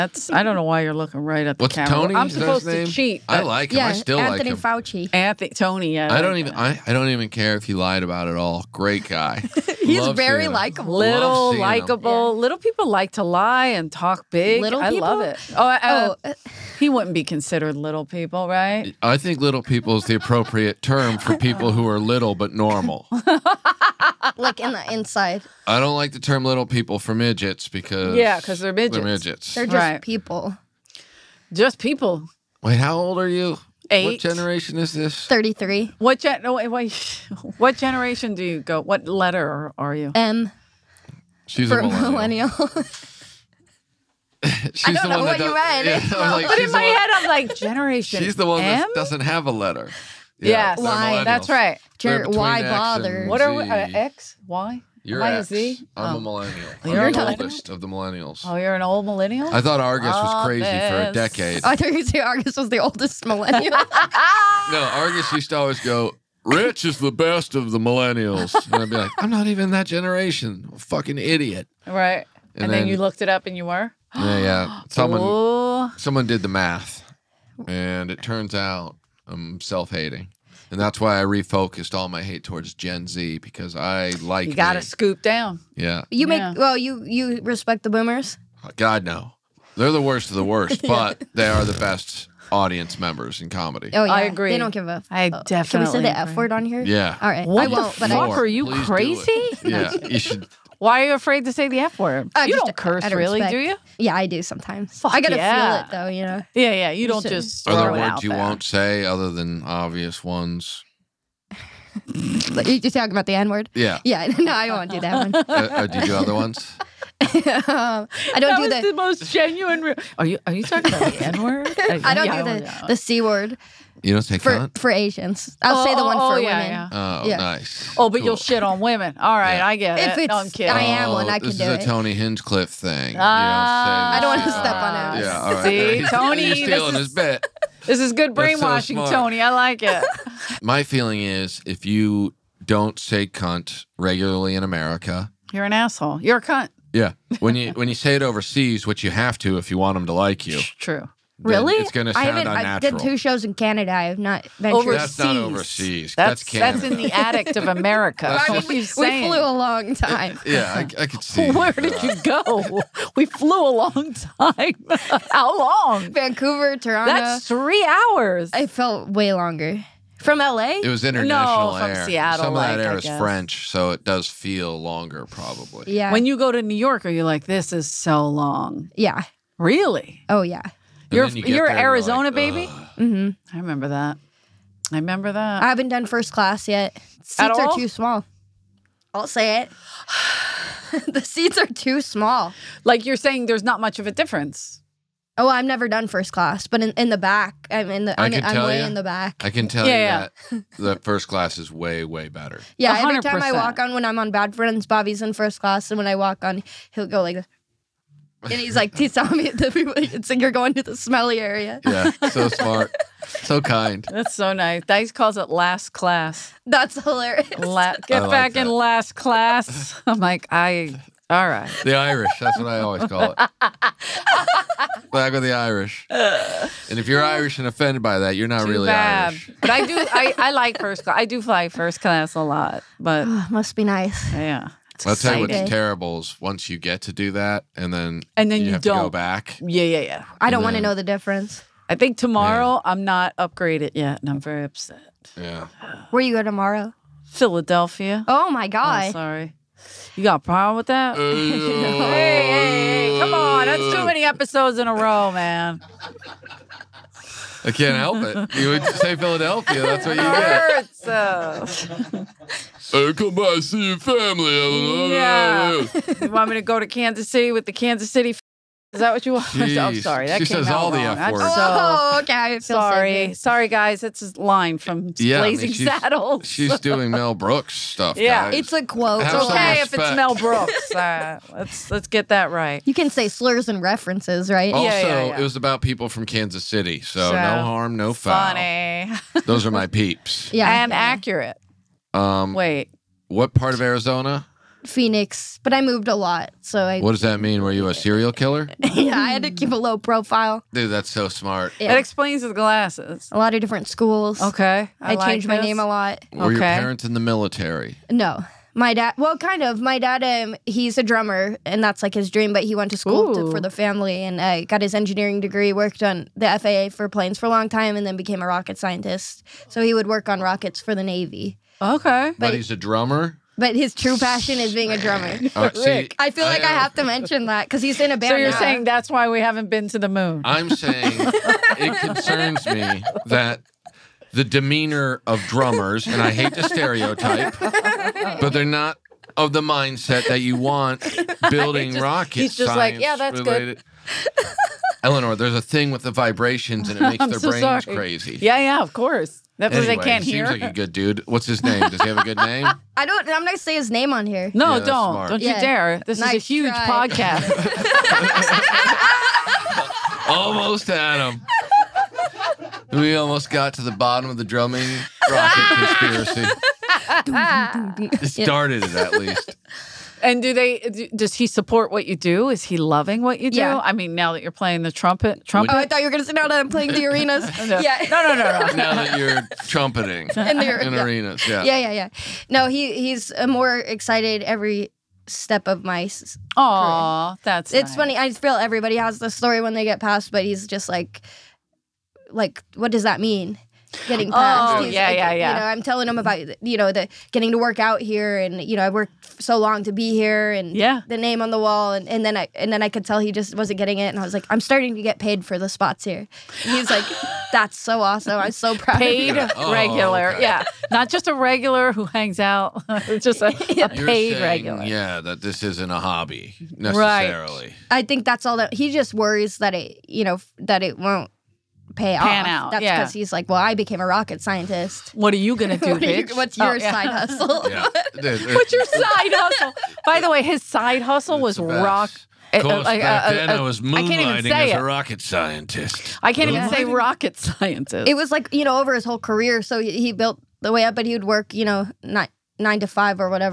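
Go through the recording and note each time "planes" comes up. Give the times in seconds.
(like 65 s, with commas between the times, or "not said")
317 s.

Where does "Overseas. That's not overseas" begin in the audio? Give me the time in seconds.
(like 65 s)
154 s.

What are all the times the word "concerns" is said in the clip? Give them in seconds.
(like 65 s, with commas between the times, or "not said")
331 s.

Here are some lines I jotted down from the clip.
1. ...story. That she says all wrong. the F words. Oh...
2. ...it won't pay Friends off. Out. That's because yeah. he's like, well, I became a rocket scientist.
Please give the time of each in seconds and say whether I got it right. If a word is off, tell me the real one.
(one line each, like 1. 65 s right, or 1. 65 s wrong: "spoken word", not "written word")
1. 269 s wrong: "sorry", not "story"
2. 420 s wrong: "Pan", not "Friends".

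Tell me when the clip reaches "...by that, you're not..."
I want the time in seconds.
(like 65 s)
228 s.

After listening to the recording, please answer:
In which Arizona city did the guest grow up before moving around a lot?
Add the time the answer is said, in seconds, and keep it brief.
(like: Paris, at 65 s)
Phoenix, at 294 s.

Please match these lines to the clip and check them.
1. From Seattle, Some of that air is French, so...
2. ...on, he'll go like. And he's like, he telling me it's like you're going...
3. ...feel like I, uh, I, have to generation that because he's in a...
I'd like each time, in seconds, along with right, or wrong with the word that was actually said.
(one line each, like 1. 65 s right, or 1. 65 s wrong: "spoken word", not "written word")
1. 171 s right
2. 206 s right
3. 326 s wrong: "mention", not "generation".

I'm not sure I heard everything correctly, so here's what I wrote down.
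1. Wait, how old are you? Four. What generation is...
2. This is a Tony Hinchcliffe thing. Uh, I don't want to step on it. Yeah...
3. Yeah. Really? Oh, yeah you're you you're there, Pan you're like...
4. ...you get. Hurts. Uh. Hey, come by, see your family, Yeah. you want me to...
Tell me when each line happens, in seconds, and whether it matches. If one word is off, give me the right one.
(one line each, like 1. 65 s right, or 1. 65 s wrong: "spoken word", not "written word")
1. 32 s wrong: "Eight", not "Four"
2. 131 s right
3. 178 s wrong: "Arizona", not "Pan"
4. 260 s right.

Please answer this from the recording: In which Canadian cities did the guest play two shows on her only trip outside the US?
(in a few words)
Vancouver, Toronto.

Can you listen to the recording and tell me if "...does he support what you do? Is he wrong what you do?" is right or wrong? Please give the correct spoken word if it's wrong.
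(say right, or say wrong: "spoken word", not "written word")
wrong: "loving", not "wrong".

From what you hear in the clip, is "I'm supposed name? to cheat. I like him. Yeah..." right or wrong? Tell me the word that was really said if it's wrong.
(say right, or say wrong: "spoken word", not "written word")
right.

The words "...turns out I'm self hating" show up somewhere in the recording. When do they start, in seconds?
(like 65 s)
78 s.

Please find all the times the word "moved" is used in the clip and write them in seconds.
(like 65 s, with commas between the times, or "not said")
295 s.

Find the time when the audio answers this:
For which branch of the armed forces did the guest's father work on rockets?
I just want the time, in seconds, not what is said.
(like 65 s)
321 s.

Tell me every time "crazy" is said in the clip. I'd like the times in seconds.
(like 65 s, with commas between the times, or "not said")
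60 s, 98 s, 347 s.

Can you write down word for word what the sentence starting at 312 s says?
But he went to school to, for the family, and uh, got his engineering degree.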